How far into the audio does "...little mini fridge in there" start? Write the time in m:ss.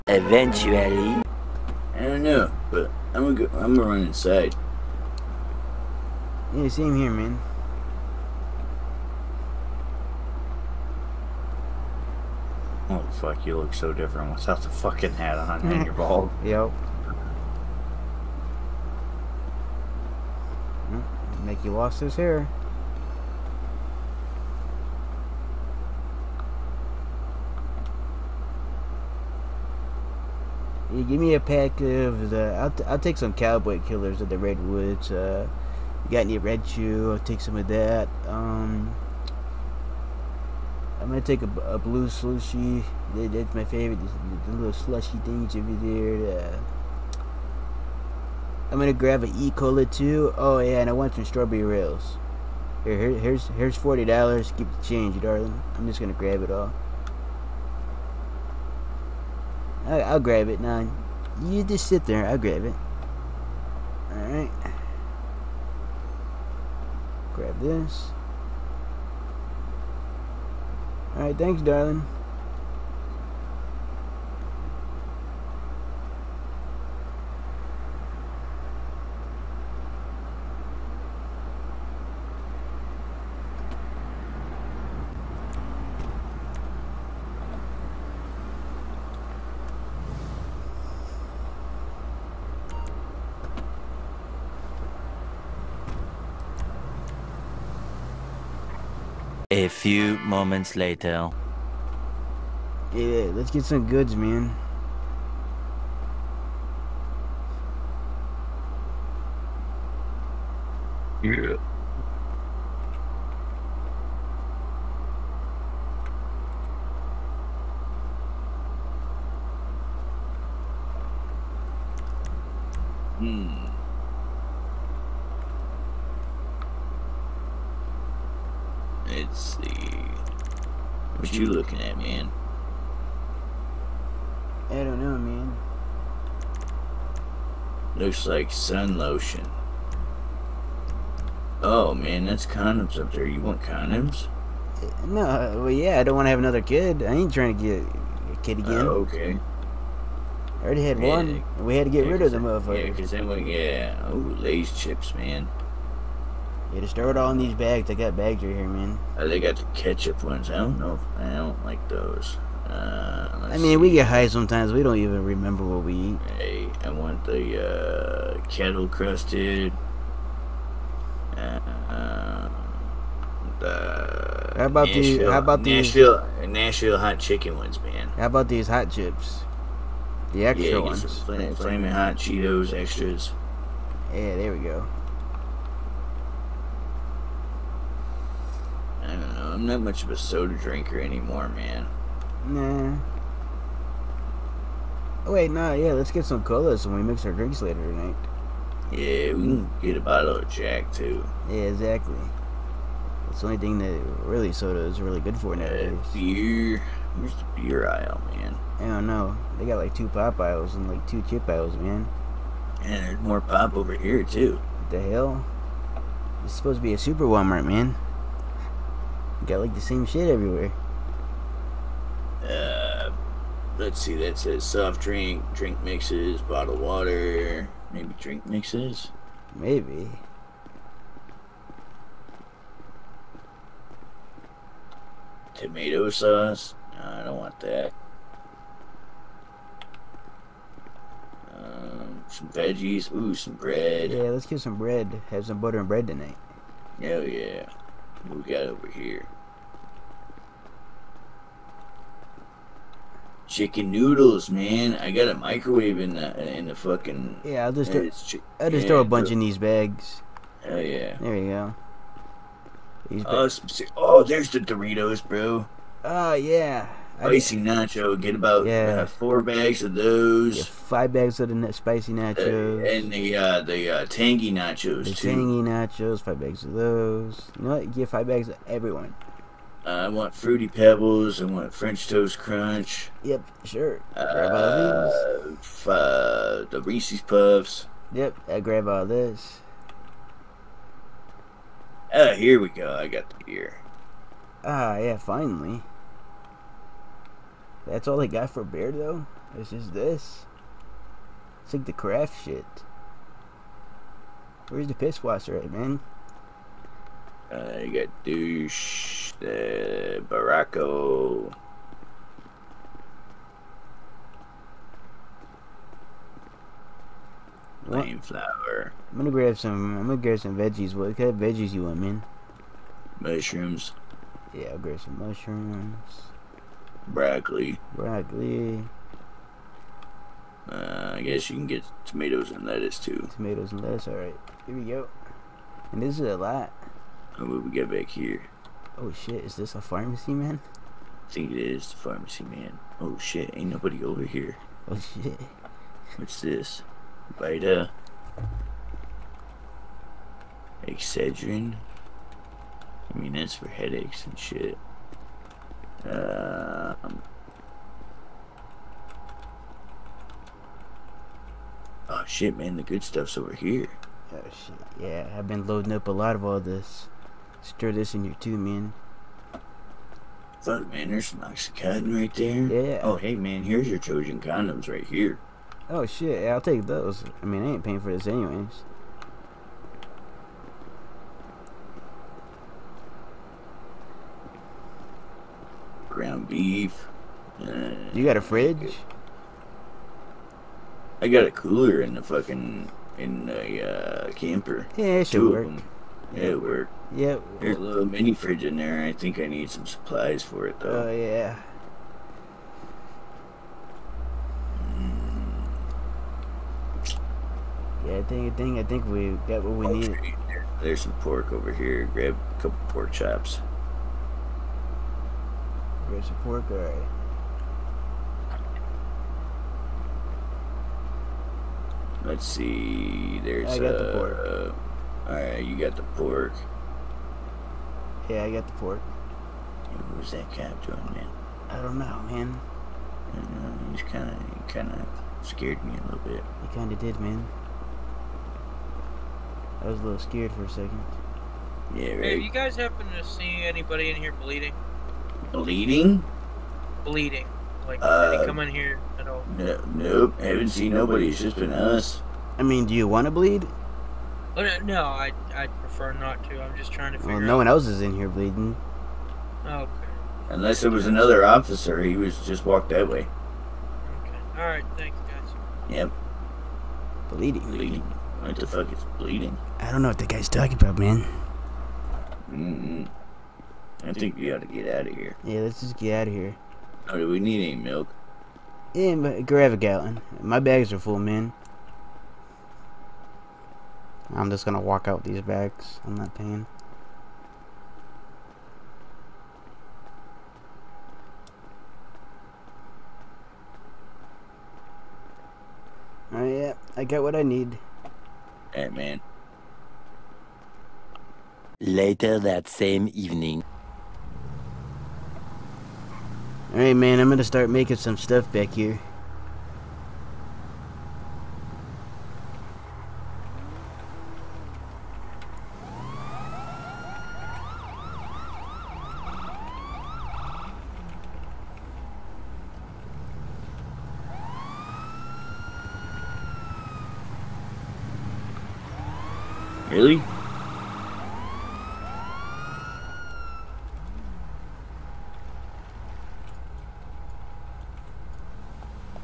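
6:37.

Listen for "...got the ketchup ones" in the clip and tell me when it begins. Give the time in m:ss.
2:39.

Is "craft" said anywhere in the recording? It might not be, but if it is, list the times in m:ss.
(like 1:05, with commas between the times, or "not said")
5:01.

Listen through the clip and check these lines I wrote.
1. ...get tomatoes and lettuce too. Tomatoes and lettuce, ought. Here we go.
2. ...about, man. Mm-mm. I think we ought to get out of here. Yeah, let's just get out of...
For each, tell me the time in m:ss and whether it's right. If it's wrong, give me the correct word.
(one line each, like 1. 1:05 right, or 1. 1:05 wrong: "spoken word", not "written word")
1. 5:31 wrong: "alright", not "ought"
2. 7:50 right.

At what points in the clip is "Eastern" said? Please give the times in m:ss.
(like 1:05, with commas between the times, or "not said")
not said.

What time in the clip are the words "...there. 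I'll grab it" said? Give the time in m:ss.
1:02.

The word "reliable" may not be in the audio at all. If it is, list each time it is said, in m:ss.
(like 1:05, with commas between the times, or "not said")
not said.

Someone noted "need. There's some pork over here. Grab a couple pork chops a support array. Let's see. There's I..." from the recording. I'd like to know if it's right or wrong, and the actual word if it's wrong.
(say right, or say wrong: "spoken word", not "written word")
right.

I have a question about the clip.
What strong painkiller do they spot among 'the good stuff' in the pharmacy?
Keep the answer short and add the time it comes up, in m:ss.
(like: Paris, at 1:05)
Oxycodone, at 6:11.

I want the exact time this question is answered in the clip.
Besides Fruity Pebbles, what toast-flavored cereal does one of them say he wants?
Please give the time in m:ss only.
4:41.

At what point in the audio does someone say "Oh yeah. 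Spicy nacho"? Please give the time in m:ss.
4:26.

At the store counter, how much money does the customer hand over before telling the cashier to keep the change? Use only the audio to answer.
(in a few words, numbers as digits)
$40.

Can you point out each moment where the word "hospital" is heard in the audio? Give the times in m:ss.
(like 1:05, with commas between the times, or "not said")
not said.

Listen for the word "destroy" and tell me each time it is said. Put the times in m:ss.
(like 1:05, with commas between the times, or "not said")
not said.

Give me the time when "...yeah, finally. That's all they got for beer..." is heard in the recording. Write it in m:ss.
4:54.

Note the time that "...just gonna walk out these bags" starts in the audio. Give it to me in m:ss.
8:04.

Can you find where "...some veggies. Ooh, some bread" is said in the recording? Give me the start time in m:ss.
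4:02.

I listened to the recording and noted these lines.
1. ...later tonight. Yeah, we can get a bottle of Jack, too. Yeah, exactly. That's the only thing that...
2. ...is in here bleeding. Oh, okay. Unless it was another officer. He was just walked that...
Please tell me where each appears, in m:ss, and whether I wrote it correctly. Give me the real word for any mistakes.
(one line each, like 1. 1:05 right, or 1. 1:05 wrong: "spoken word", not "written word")
1. 3:17 right
2. 7:37 right.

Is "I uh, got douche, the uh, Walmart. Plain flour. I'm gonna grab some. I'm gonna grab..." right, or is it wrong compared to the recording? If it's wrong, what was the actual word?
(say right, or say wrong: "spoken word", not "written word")
wrong: "Baracko", not "Walmart".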